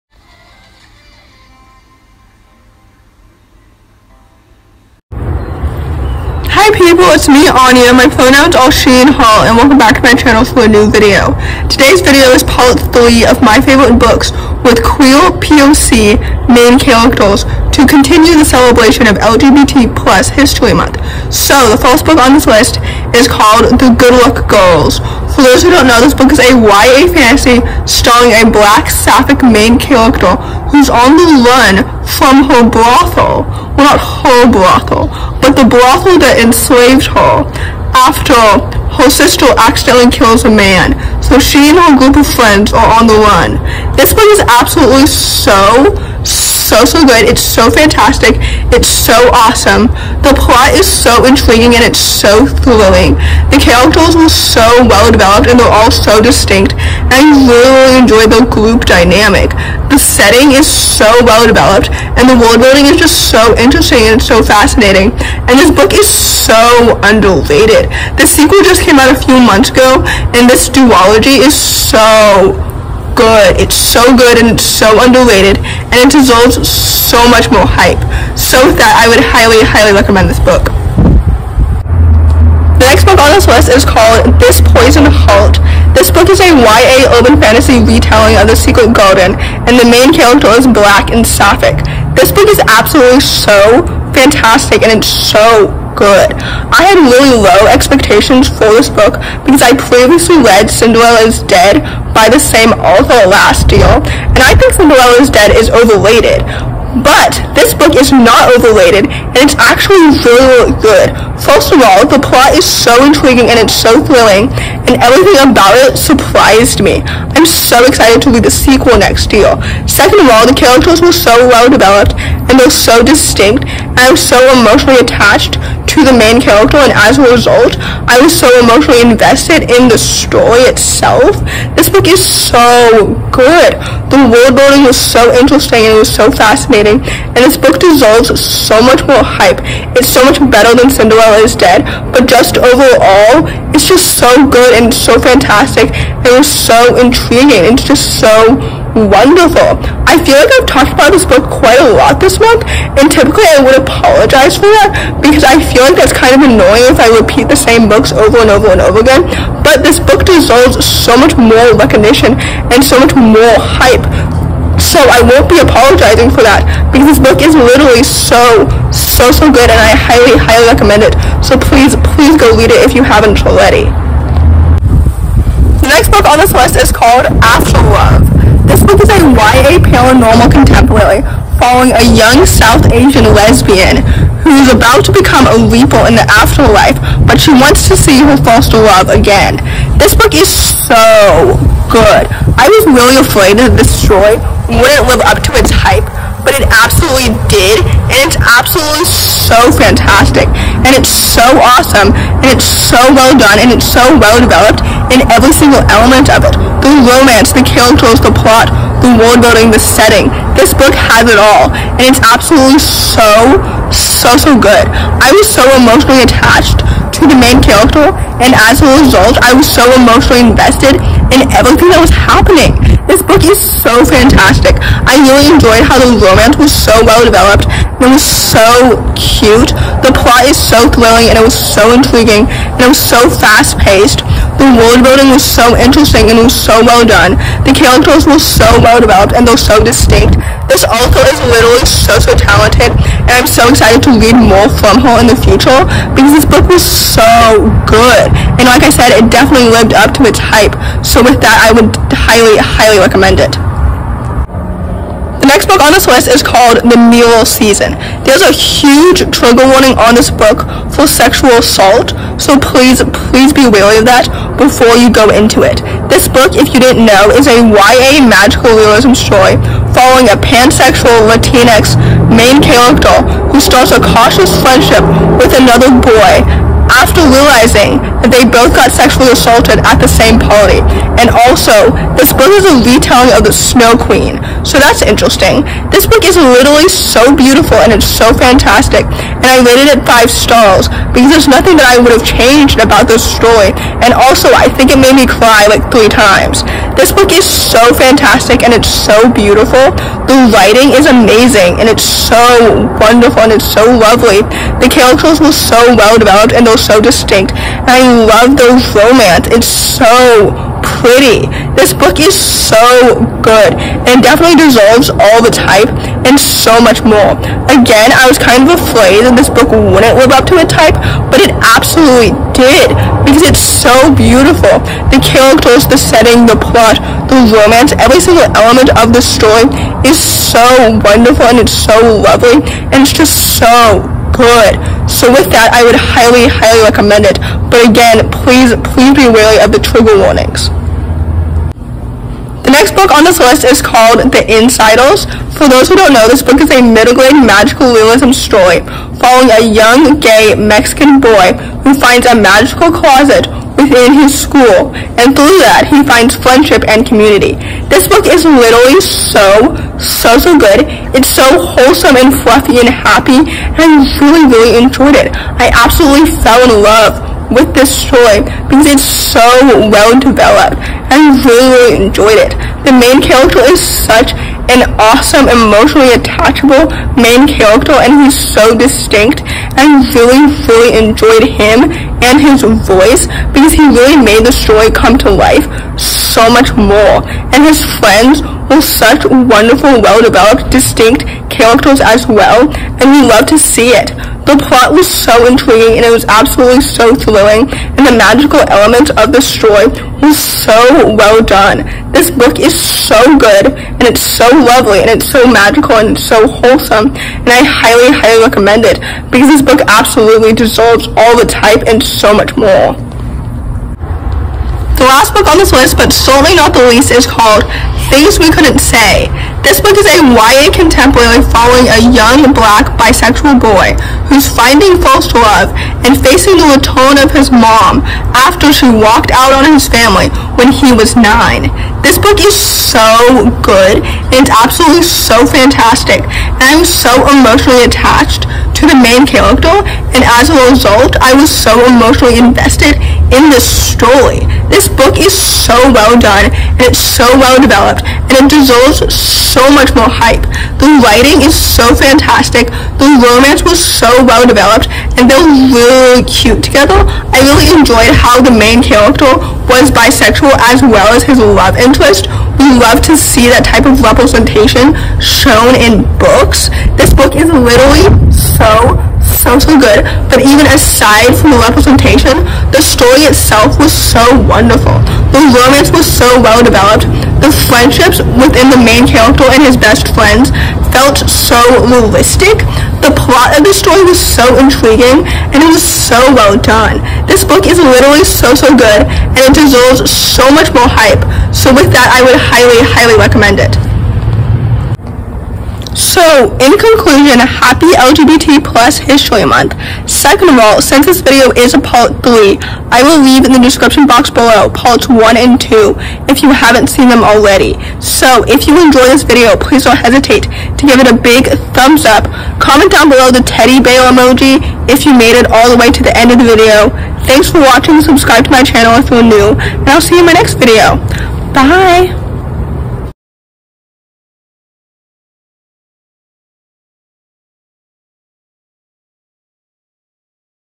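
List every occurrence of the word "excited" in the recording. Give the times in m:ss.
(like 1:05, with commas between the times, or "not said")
1:57, 4:03.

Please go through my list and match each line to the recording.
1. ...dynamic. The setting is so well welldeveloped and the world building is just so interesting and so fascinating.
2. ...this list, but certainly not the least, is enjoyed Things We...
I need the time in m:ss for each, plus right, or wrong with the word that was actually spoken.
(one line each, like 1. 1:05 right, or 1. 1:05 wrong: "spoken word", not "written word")
1. 0:58 wrong: "developed", not "welldeveloped"
2. 6:55 wrong: "called", not "enjoyed".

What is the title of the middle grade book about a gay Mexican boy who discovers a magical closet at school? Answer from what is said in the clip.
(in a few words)
The Insiders.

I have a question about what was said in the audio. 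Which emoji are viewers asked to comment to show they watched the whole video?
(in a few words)
teddy bear.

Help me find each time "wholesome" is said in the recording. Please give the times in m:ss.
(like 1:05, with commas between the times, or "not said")
6:01, 6:46.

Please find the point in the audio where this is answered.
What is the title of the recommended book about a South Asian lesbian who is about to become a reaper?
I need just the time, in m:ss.
2:57.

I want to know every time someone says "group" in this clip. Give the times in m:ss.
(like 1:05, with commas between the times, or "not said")
0:41, 0:58.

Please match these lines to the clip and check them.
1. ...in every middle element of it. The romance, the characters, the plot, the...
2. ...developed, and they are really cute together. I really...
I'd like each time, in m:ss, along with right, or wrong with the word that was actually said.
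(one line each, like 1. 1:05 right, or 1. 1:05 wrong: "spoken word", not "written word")
1. 3:25 wrong: "single", not "middle"
2. 7:34 right.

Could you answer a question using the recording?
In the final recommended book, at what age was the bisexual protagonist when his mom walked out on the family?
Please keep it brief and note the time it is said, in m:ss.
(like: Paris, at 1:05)
9, at 7:11.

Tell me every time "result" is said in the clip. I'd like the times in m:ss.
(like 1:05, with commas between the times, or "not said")
2:07, 3:38, 7:20.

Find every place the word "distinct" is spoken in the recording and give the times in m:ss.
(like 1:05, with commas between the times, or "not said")
0:56, 2:03, 3:59, 5:07, 6:18, 6:30.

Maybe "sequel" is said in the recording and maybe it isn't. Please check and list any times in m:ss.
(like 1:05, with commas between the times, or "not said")
1:08, 1:58.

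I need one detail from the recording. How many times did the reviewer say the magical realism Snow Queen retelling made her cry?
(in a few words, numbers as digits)
3.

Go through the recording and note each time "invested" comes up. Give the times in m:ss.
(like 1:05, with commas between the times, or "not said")
2:09, 3:40, 7:22.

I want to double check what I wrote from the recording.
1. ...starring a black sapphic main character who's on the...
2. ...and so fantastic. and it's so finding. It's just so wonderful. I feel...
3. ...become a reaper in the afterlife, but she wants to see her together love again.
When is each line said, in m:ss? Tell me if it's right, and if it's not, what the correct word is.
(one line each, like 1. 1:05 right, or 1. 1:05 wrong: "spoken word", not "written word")
1. 0:27 right
2. 2:24 wrong: "intriguing", not "finding"
3. 3:05 wrong: "foster", not "together".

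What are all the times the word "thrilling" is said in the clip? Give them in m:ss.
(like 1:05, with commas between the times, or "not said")
0:52, 1:54, 3:50, 6:37.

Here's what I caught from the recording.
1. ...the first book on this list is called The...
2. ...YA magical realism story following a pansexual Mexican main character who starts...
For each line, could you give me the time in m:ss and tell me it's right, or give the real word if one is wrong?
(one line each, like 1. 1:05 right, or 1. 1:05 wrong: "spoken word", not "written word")
1. 0:21 right
2. 4:27 wrong: "Latinx", not "Mexican".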